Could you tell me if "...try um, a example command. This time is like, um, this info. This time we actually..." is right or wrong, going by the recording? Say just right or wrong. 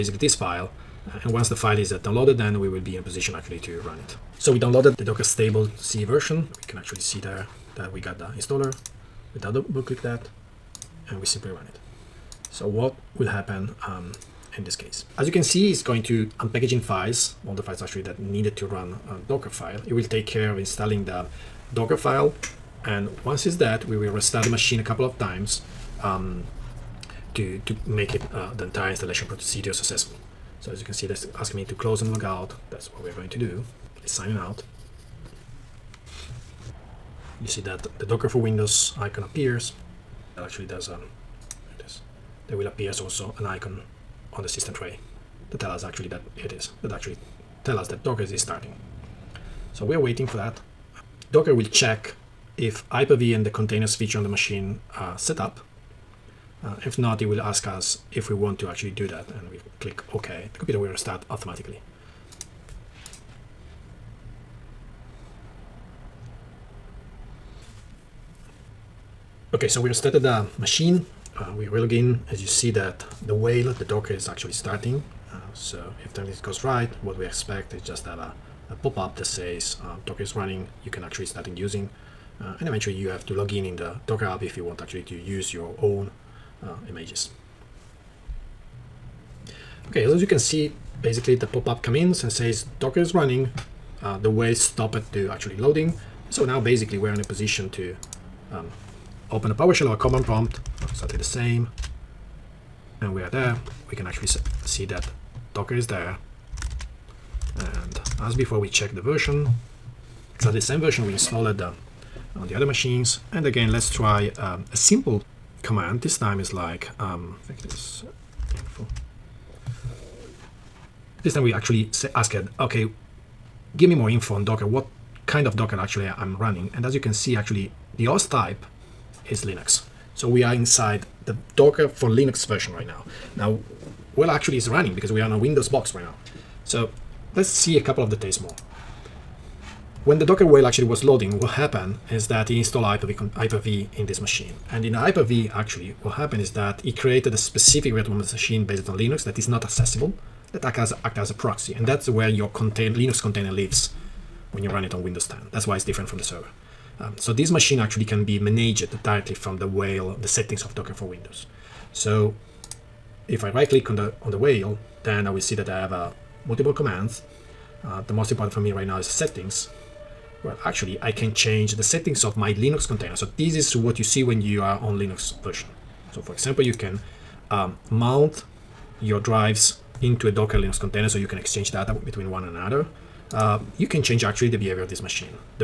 wrong.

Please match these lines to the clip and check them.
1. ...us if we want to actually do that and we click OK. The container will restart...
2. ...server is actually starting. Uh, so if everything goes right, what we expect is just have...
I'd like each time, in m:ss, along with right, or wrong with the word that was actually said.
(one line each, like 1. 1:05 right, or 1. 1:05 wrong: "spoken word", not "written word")
1. 0:57 wrong: "computer", not "container"
2. 1:13 wrong: "docker", not "server".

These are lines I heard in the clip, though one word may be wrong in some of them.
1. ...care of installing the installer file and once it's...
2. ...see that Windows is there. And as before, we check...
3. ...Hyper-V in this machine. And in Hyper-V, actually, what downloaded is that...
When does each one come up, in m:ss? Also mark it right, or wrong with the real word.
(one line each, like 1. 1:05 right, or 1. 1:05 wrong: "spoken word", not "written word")
1. 0:20 wrong: "docker", not "installer"
2. 1:44 wrong: "Docker", not "Windows"
3. 2:23 wrong: "happened", not "downloaded".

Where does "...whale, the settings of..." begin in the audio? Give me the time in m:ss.
2:39.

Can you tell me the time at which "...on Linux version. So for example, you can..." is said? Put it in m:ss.
2:54.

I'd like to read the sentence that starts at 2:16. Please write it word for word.
So let's see a couple of details more.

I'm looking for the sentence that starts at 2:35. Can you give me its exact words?
That's why it's different from the server.